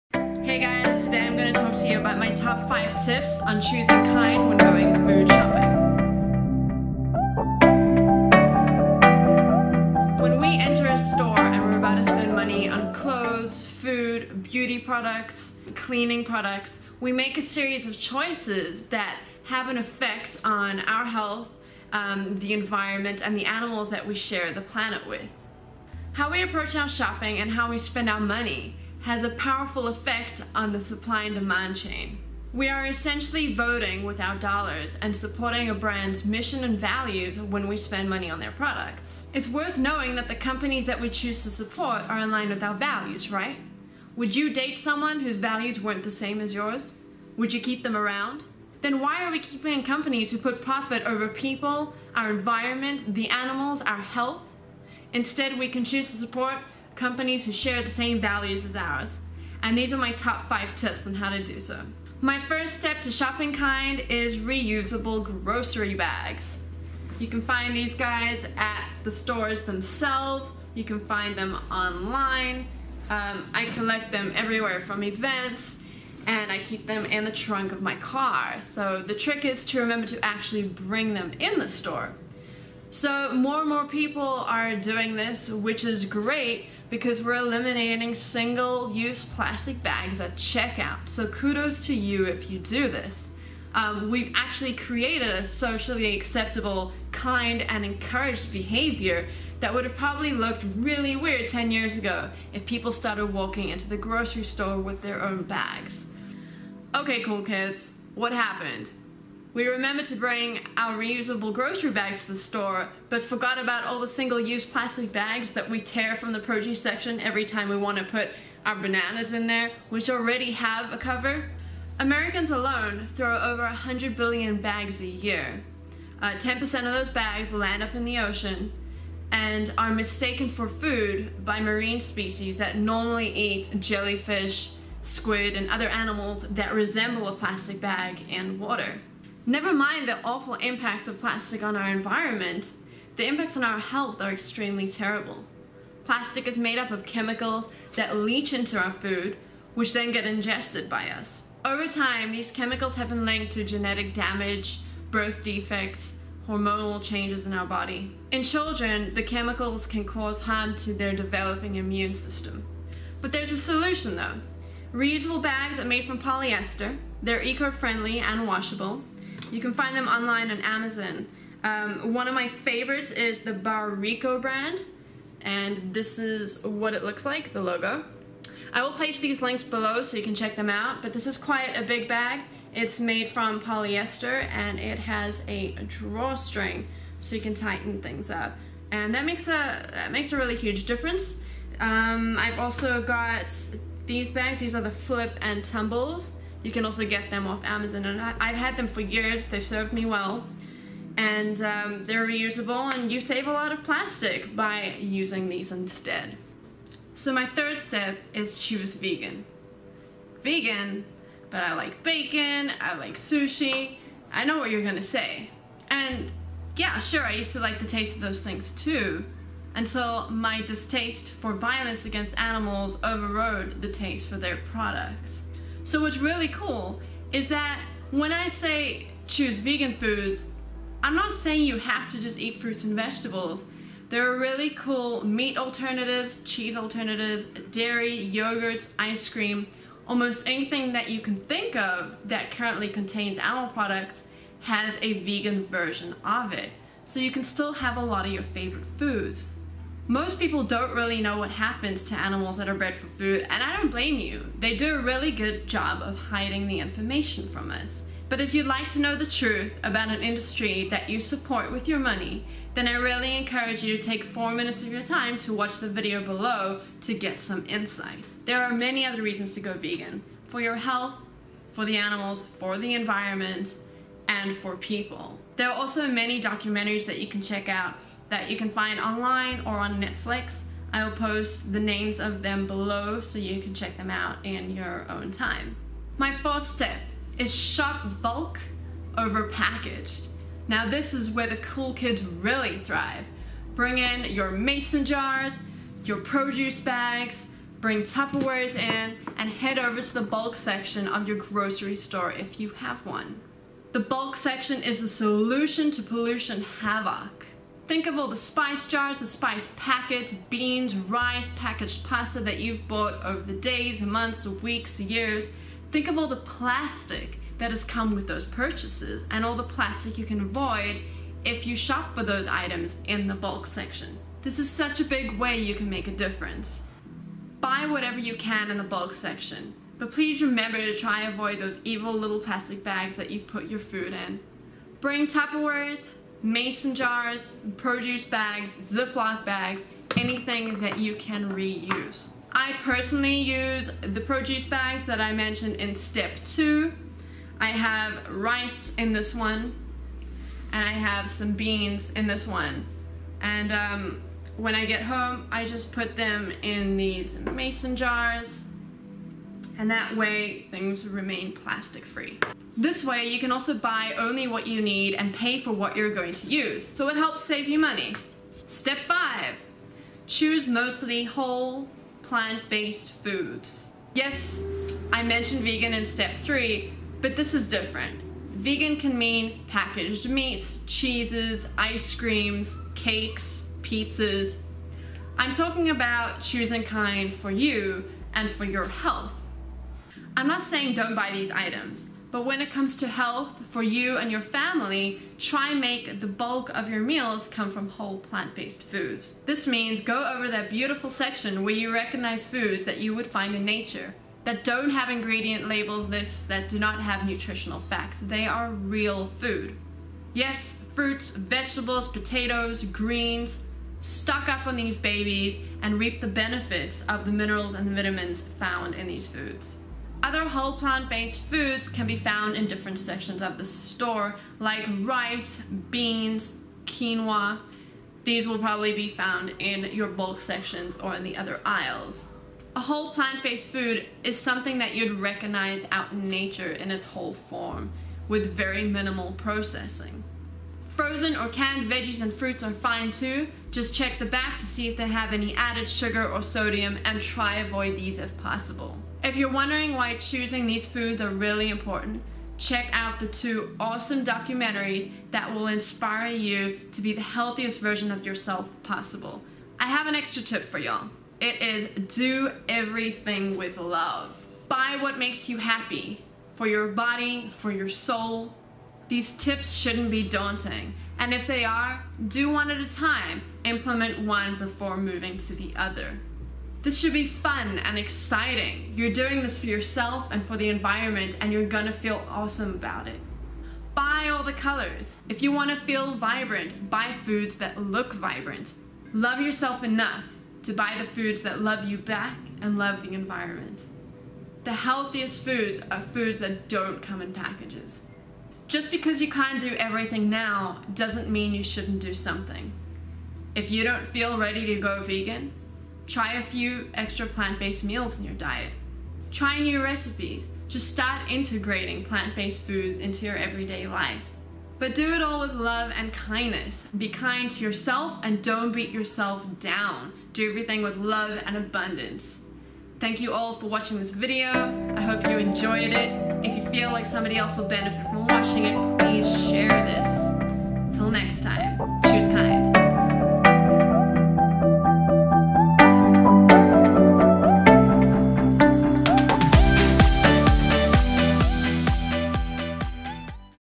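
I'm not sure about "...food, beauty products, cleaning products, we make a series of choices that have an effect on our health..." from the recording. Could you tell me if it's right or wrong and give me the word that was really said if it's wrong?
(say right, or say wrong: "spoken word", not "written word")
right.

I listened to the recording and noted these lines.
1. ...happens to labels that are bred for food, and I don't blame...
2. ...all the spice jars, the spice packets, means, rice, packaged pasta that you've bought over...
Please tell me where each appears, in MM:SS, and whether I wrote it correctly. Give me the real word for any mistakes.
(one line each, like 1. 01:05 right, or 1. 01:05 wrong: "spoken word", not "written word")
1. 04:11 wrong: "animals", not "labels"
2. 05:08 wrong: "beans", not "means".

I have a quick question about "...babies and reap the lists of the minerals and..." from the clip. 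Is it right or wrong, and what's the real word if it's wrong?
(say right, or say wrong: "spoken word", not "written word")
wrong: "benefits", not "lists".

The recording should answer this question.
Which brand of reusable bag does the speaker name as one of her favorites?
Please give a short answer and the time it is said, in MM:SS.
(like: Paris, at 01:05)
Barrico, at 02:53.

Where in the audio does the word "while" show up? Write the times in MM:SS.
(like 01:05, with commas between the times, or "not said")
not said.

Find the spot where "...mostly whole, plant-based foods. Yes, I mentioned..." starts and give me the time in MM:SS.
06:10.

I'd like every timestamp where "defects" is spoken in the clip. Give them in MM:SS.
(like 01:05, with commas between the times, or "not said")
02:35.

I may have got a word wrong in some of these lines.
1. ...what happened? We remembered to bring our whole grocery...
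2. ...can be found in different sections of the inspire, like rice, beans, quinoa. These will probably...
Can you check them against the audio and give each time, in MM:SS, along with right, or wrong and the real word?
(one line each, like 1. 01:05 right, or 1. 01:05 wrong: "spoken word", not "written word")
1. 01:48 wrong: "reusable", not "whole"
2. 07:01 wrong: "store", not "inspire".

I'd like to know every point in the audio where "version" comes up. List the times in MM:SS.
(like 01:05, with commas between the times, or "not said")
04:05, 07:37.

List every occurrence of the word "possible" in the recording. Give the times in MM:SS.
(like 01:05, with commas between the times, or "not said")
07:28, 07:38.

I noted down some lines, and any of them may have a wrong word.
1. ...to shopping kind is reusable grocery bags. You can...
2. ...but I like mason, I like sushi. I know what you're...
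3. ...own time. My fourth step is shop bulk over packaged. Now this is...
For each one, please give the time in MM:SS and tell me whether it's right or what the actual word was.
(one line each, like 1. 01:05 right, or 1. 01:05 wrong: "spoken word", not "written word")
1. 01:03 right
2. 03:31 wrong: "bacon", not "mason"
3. 04:45 right.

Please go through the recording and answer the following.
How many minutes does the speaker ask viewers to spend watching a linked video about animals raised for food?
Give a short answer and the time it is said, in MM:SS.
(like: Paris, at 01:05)
4, at 04:24.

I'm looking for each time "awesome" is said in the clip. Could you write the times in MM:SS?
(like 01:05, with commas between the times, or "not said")
07:33, 08:02.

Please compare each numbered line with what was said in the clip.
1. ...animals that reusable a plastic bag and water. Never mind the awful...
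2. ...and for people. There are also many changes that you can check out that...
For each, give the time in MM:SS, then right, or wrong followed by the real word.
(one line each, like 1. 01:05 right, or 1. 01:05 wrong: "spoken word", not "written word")
1. 02:15 wrong: "resemble", not "reusable"
2. 04:34 wrong: "documentaries", not "changes".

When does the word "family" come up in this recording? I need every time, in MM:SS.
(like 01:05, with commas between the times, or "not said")
06:34.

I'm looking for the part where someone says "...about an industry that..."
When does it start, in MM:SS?
04:19.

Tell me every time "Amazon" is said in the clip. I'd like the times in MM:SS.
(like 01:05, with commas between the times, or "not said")
02:50, 03:17.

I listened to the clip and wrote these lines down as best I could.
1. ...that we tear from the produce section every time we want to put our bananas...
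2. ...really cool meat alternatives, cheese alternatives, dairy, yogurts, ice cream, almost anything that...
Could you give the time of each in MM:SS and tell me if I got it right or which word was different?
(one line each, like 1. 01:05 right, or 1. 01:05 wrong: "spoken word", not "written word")
1. 01:55 right
2. 03:54 right.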